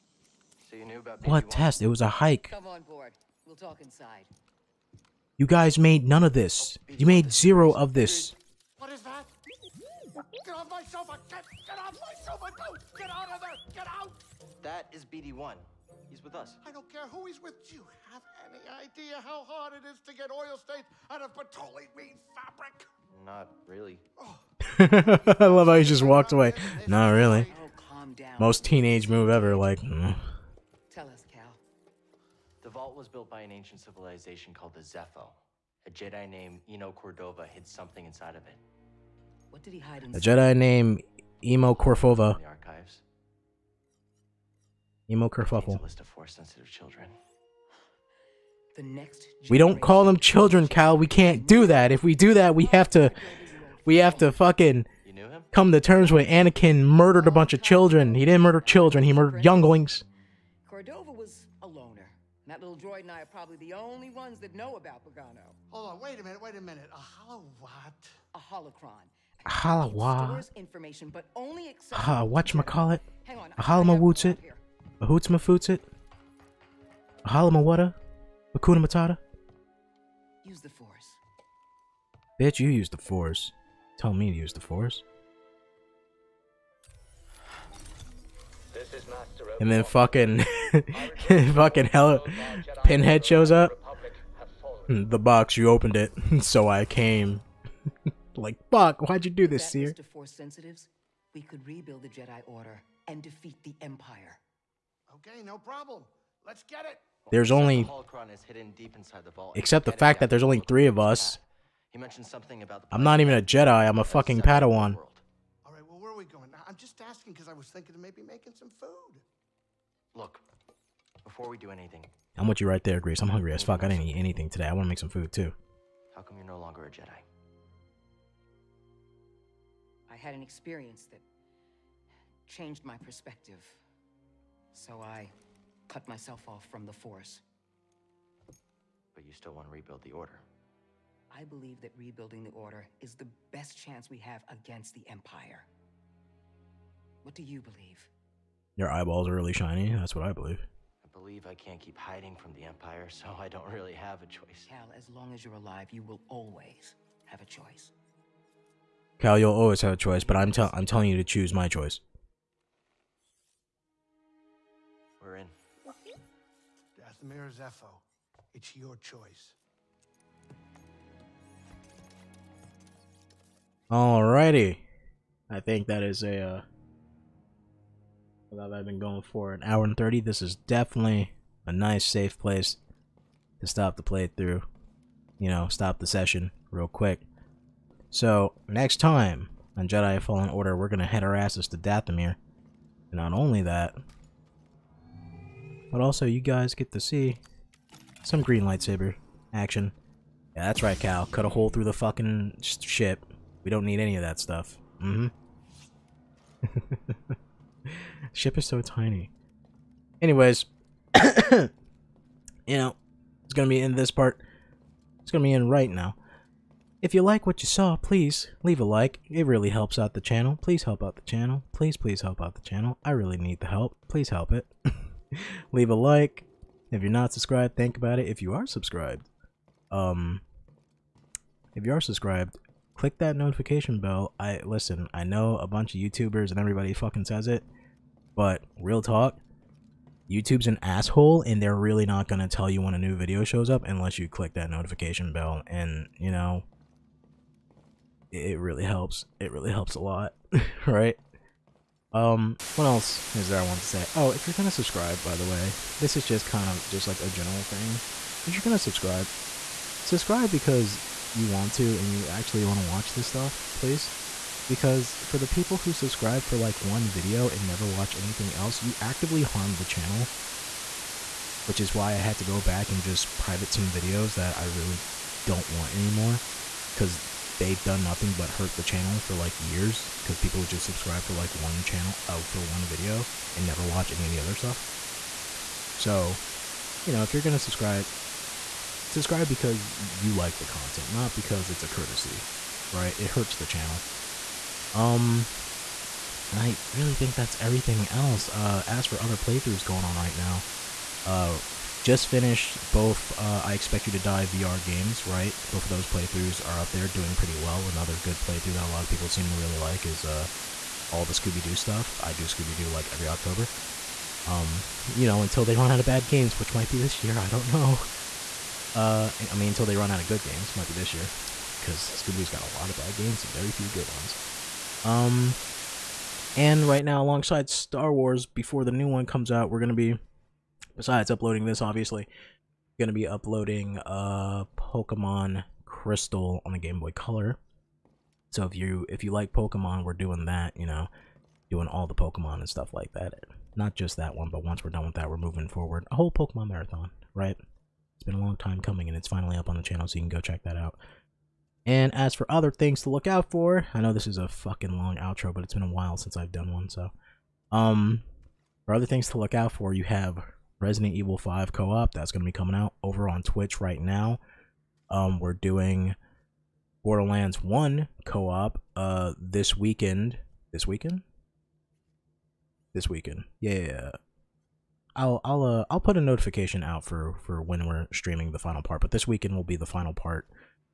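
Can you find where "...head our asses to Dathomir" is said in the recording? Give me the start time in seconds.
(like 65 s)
191 s.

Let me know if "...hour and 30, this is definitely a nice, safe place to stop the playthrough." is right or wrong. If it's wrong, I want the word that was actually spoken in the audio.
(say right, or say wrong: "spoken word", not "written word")
right.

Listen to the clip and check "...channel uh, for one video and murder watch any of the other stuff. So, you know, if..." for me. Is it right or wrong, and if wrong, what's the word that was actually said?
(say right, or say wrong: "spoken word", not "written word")
wrong: "never", not "murder".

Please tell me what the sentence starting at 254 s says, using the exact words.
Oh, if you're going to subscribe, by the way, this is just kind of just like a general thing.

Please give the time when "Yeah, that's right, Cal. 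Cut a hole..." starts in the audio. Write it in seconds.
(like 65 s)
200 s.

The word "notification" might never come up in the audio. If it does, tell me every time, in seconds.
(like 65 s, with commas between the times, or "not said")
233 s, 244 s, 376 s.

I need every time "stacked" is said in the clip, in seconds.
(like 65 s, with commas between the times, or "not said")
not said.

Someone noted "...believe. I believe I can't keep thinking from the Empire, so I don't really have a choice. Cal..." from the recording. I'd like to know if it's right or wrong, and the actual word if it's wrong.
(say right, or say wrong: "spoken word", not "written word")
wrong: "hiding", not "thinking".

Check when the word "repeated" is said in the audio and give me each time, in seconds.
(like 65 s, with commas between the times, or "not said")
not said.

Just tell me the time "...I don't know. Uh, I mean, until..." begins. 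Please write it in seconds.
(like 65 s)
317 s.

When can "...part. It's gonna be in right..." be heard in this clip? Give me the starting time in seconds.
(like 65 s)
214 s.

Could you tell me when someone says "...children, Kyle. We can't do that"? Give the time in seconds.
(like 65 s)
50 s.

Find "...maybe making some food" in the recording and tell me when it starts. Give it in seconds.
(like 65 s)
118 s.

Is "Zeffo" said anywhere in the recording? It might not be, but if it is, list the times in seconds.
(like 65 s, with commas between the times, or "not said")
34 s, 167 s.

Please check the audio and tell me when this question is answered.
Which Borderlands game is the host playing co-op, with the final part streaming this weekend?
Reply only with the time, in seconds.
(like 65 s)
367 s.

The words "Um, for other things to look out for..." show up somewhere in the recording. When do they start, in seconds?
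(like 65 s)
357 s.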